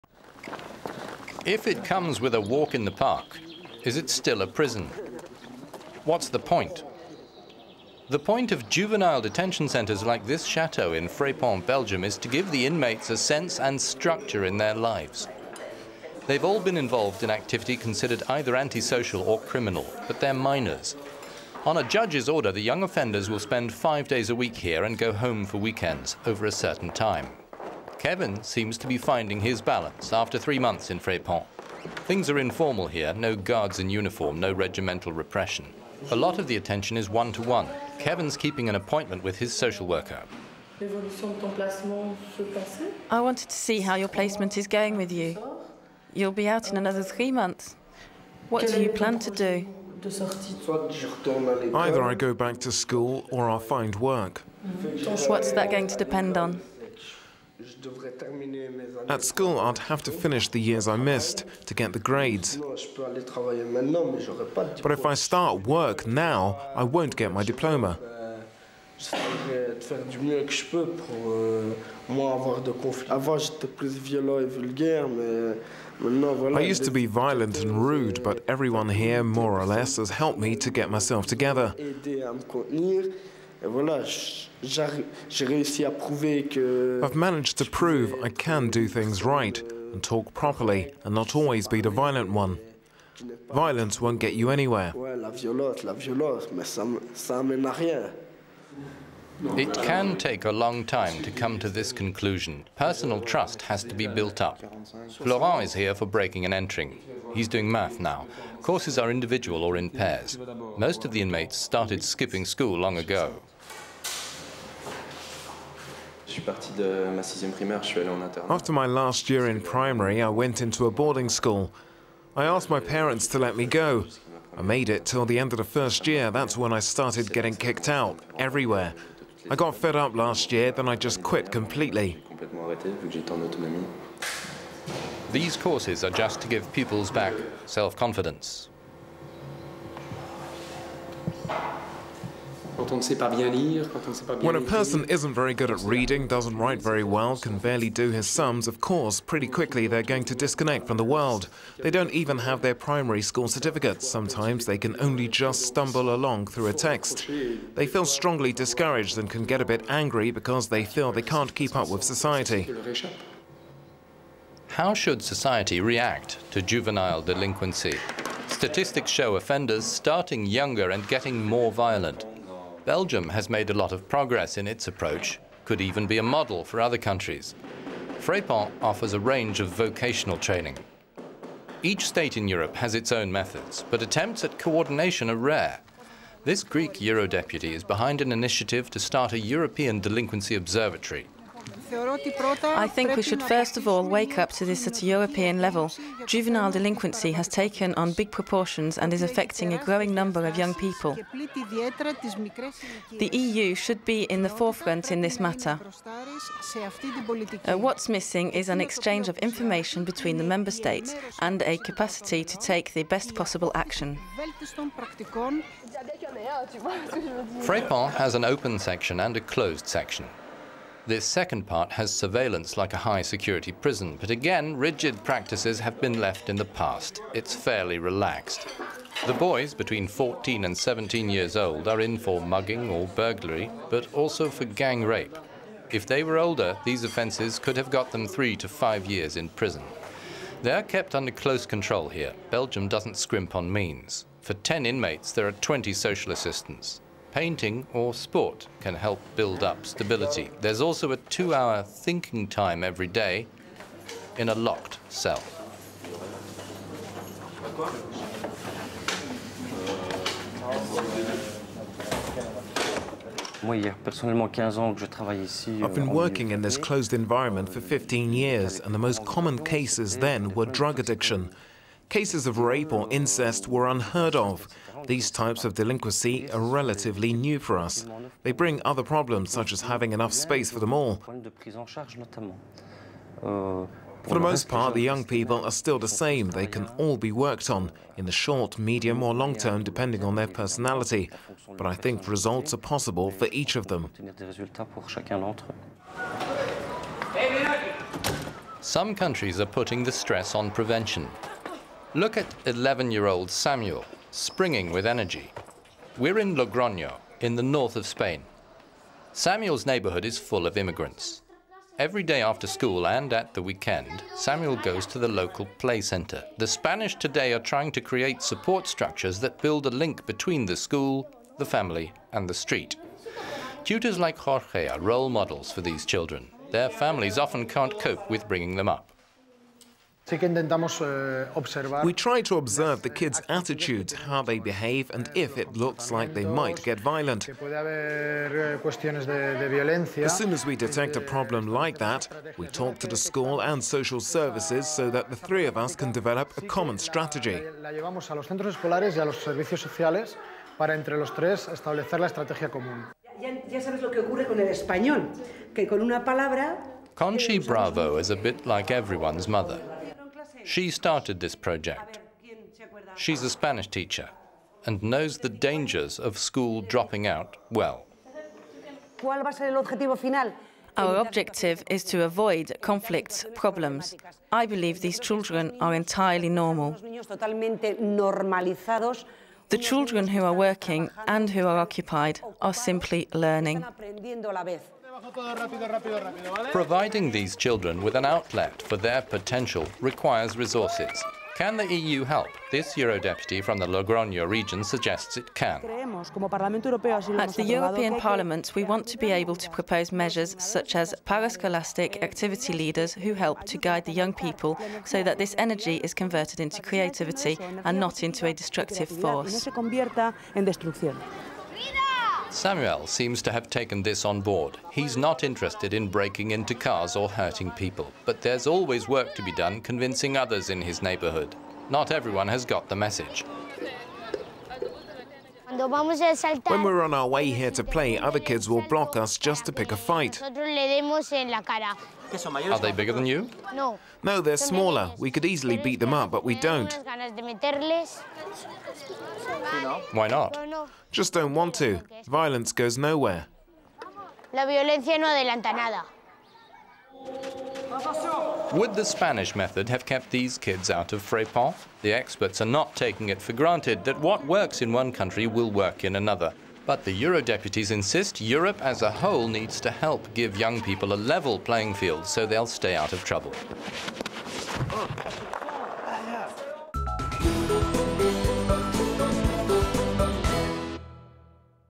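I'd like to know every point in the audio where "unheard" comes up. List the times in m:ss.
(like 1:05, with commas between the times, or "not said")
4:33.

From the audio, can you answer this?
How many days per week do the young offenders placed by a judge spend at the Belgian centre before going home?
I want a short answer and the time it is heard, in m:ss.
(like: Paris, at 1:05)
5, at 0:23.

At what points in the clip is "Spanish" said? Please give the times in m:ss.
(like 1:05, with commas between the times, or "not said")
5:16, 6:03, 7:29.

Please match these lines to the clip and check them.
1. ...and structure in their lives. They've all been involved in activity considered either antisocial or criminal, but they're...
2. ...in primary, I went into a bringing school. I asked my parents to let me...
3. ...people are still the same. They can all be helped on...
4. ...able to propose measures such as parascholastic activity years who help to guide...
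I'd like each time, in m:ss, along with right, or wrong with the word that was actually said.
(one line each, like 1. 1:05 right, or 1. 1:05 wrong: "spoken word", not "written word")
1. 0:13 right
2. 1:59 wrong: "boarding", not "bringing"
3. 4:45 wrong: "worked", not "helped"
4. 6:39 wrong: "leaders", not "years".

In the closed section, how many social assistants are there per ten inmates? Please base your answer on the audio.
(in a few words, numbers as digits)
20.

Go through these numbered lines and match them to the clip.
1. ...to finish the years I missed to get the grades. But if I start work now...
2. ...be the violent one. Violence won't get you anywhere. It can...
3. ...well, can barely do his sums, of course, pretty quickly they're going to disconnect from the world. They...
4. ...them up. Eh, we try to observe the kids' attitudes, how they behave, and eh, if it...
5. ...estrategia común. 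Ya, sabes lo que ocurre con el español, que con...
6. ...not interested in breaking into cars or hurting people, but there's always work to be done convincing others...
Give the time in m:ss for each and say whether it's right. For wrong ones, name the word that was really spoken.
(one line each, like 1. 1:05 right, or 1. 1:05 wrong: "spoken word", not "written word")
1. 1:00 right
2. 1:31 right
3. 2:27 right
4. 5:28 right
5. 5:52 right
6. 6:55 right.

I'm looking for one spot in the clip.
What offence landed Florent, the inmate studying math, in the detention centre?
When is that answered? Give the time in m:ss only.
1:46.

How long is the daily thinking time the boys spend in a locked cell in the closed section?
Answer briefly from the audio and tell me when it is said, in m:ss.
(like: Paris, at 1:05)
2 hours, at 4:11.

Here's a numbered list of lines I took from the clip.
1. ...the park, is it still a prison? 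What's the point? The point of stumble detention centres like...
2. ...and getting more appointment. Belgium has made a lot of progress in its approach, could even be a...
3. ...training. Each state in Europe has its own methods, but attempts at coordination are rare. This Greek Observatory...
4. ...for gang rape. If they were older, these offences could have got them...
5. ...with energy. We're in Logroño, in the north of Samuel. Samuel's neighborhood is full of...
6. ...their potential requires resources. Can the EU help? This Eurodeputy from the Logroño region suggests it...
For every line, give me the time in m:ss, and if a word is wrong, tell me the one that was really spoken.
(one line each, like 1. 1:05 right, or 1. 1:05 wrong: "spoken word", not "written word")
1. 0:02 wrong: "juvenile", not "stumble"
2. 2:50 wrong: "violent", not "appointment"
3. 3:00 wrong: "Eurodeputy", not "Observatory"
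4. 3:54 right
5. 5:04 wrong: "Spain", not "Samuel"
6. 6:28 right.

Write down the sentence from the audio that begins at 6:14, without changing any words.
I believe these children are entirely normal.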